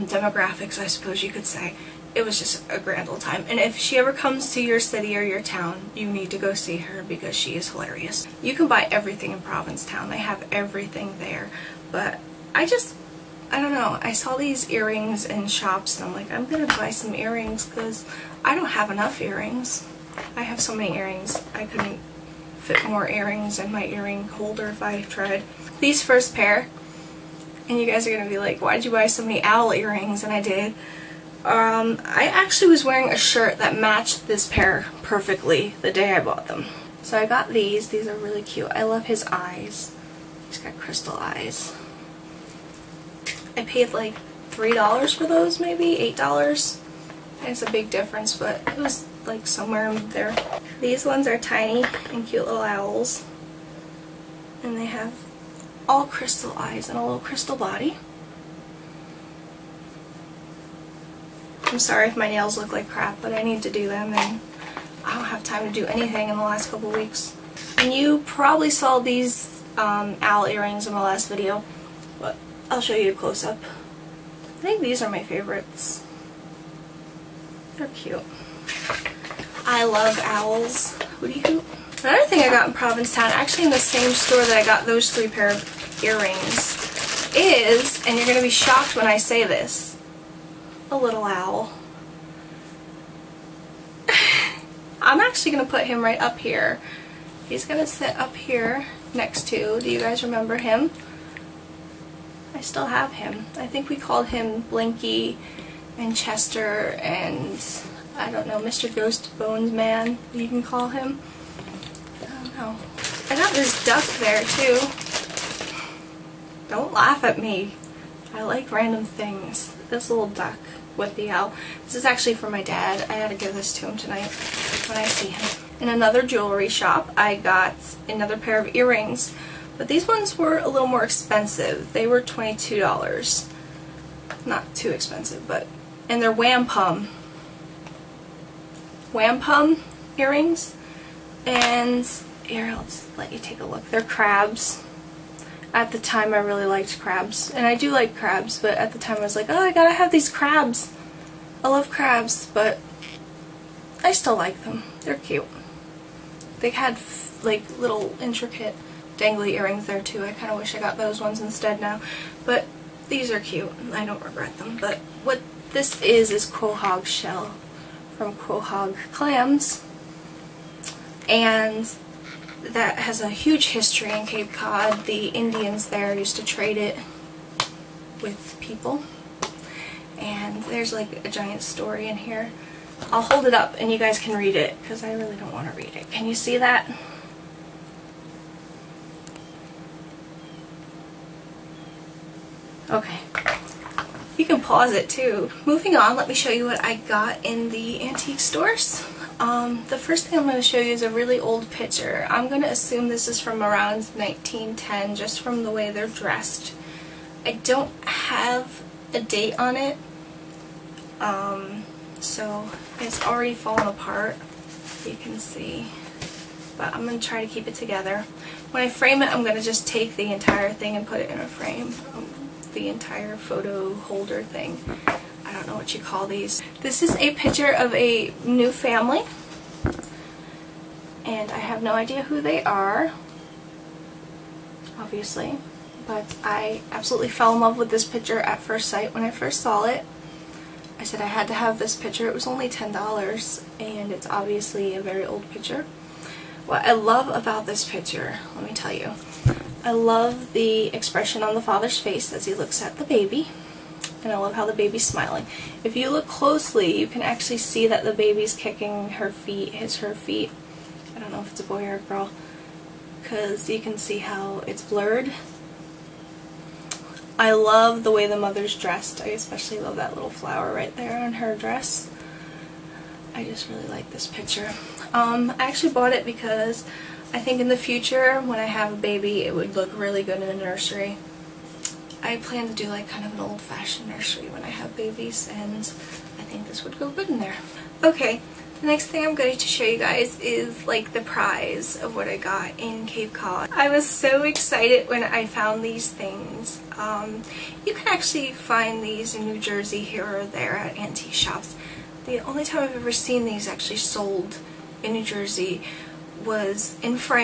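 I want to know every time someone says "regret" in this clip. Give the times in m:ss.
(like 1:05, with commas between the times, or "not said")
2:44.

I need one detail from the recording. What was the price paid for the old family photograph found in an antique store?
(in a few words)
$10.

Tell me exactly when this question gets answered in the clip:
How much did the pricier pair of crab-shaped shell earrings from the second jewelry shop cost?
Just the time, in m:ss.
2:12.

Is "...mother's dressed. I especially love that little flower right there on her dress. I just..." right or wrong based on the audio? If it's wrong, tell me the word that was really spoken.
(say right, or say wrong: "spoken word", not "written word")
right.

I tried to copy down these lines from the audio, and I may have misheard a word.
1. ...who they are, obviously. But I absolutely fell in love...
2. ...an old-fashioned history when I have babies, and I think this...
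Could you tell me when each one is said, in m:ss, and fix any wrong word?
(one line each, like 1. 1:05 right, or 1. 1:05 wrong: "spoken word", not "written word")
1. 3:52 right
2. 4:43 wrong: "nursery", not "history".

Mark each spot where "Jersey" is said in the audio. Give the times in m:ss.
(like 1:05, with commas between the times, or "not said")
4:59, 5:05.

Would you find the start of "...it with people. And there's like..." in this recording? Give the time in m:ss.
2:56.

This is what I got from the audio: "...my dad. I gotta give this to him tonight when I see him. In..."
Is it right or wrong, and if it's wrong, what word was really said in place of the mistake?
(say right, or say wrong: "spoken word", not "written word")
right.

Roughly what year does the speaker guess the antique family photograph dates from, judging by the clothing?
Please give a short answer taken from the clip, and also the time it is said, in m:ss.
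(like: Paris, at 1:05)
1910, at 3:24.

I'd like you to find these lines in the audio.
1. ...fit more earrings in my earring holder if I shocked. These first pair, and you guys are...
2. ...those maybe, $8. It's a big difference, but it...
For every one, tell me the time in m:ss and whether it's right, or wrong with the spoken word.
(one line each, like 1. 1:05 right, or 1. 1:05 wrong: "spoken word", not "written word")
1. 0:22 wrong: "tried", not "shocked"
2. 0:45 right.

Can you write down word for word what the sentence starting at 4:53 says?
I was so excited when I found these things.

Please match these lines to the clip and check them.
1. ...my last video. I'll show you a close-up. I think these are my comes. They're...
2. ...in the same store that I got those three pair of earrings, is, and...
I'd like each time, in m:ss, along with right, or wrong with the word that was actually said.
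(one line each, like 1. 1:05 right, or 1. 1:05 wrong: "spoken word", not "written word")
1. 1:10 wrong: "favorites", not "comes"
2. 1:23 right.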